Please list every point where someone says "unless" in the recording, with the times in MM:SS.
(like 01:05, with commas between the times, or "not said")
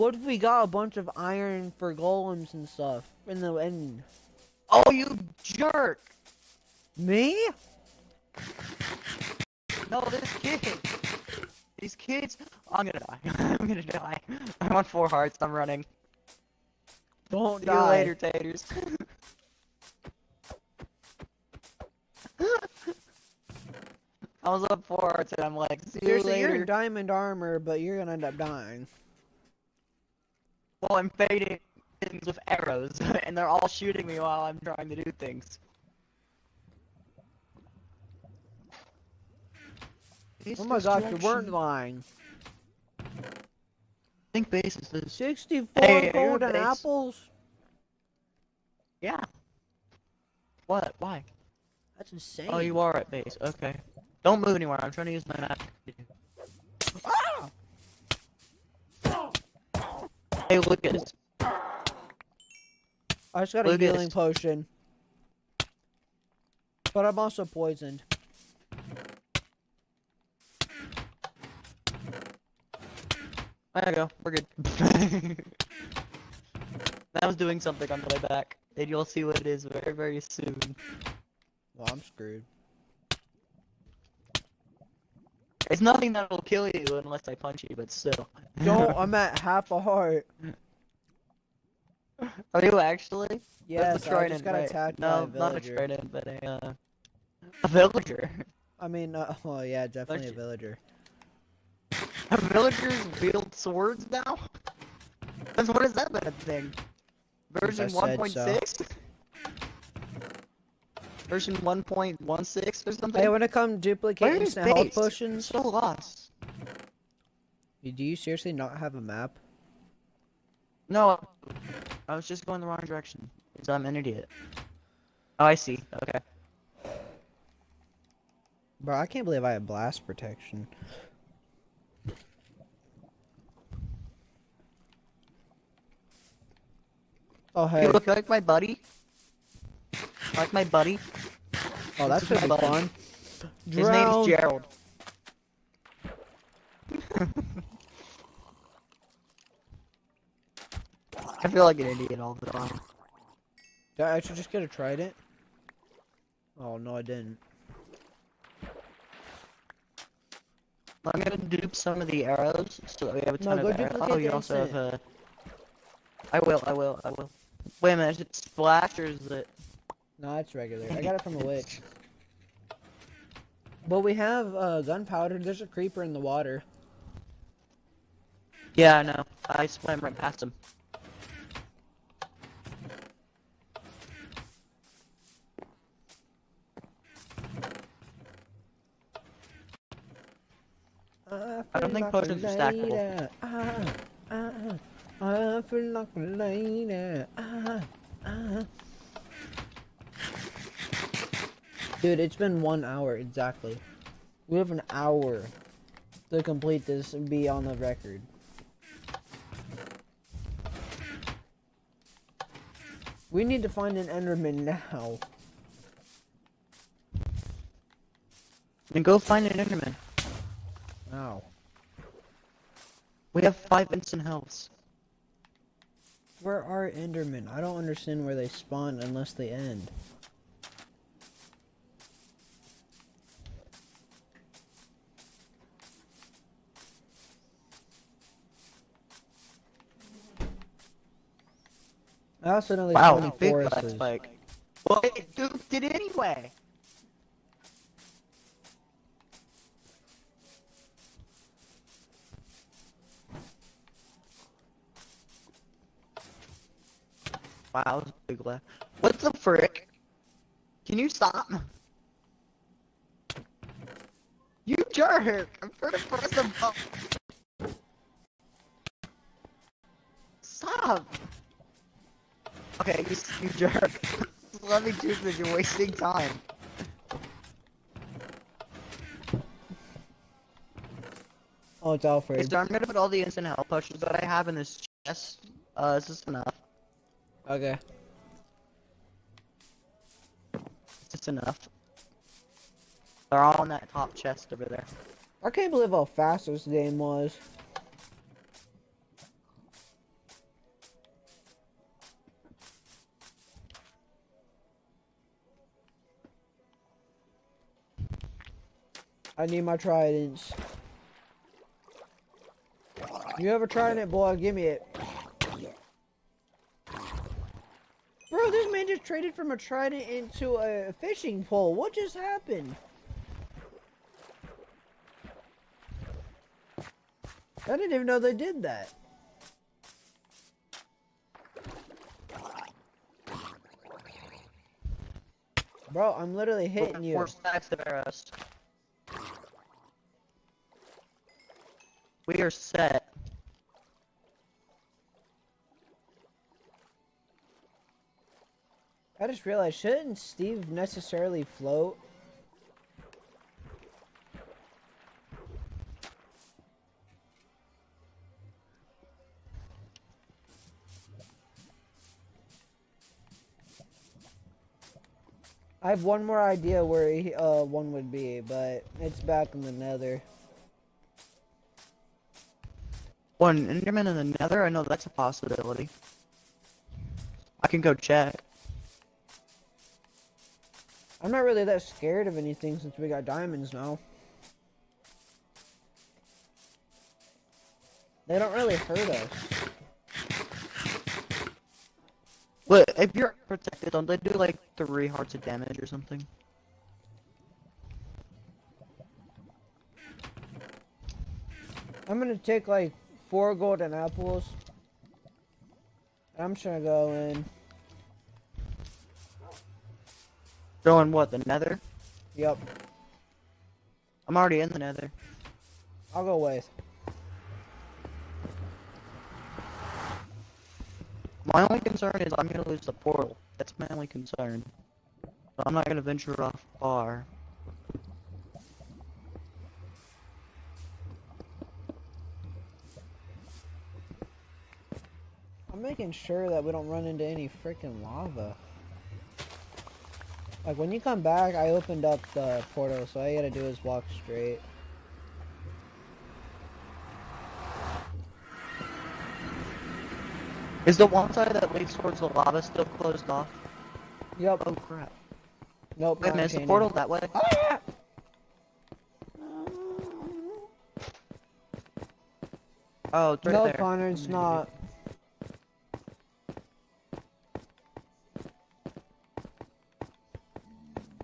01:27, 03:48.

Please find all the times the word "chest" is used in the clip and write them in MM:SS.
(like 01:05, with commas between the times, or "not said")
04:45, 04:54.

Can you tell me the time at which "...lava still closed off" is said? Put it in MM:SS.
07:32.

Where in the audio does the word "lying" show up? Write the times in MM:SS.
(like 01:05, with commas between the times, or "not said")
00:41.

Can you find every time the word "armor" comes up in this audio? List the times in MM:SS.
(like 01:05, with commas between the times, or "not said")
00:27.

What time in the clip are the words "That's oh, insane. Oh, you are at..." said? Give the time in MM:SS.
00:51.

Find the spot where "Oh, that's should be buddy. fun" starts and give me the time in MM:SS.
02:21.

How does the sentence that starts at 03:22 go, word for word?
Dude, it's been one hour exactly.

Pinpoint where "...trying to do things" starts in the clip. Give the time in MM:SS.
00:34.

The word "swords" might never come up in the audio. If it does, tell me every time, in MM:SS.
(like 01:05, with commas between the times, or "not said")
01:43.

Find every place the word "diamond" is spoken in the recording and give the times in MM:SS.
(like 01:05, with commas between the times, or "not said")
00:26, 06:23.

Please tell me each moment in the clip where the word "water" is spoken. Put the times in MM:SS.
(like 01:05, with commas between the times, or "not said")
02:56.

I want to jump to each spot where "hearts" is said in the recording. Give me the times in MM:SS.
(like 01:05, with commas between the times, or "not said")
00:15, 00:25, 01:29, 06:35.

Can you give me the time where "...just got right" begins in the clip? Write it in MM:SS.
01:34.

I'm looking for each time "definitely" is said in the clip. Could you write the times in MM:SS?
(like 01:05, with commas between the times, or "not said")
01:39.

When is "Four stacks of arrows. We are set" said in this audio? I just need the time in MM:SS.
05:37.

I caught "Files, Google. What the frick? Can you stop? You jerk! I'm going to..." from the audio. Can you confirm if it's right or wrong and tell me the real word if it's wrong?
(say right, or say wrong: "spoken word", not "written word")
right.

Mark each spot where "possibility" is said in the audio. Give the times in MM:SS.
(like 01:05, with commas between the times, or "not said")
06:15.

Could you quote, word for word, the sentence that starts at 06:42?
I'm gonna take like four golden apples.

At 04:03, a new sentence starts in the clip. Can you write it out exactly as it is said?
Like, well, it duped it anyway.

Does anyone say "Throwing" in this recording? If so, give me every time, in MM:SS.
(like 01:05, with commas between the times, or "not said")
06:50.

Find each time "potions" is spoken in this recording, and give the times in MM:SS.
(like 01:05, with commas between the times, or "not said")
01:04, 01:54, 03:12, 04:43.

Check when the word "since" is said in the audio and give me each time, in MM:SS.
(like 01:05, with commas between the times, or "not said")
01:45, 06:22.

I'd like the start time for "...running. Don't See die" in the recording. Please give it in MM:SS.
00:15.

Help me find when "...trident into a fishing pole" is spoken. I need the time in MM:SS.
05:19.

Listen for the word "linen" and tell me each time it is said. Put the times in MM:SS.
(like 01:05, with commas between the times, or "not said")
not said.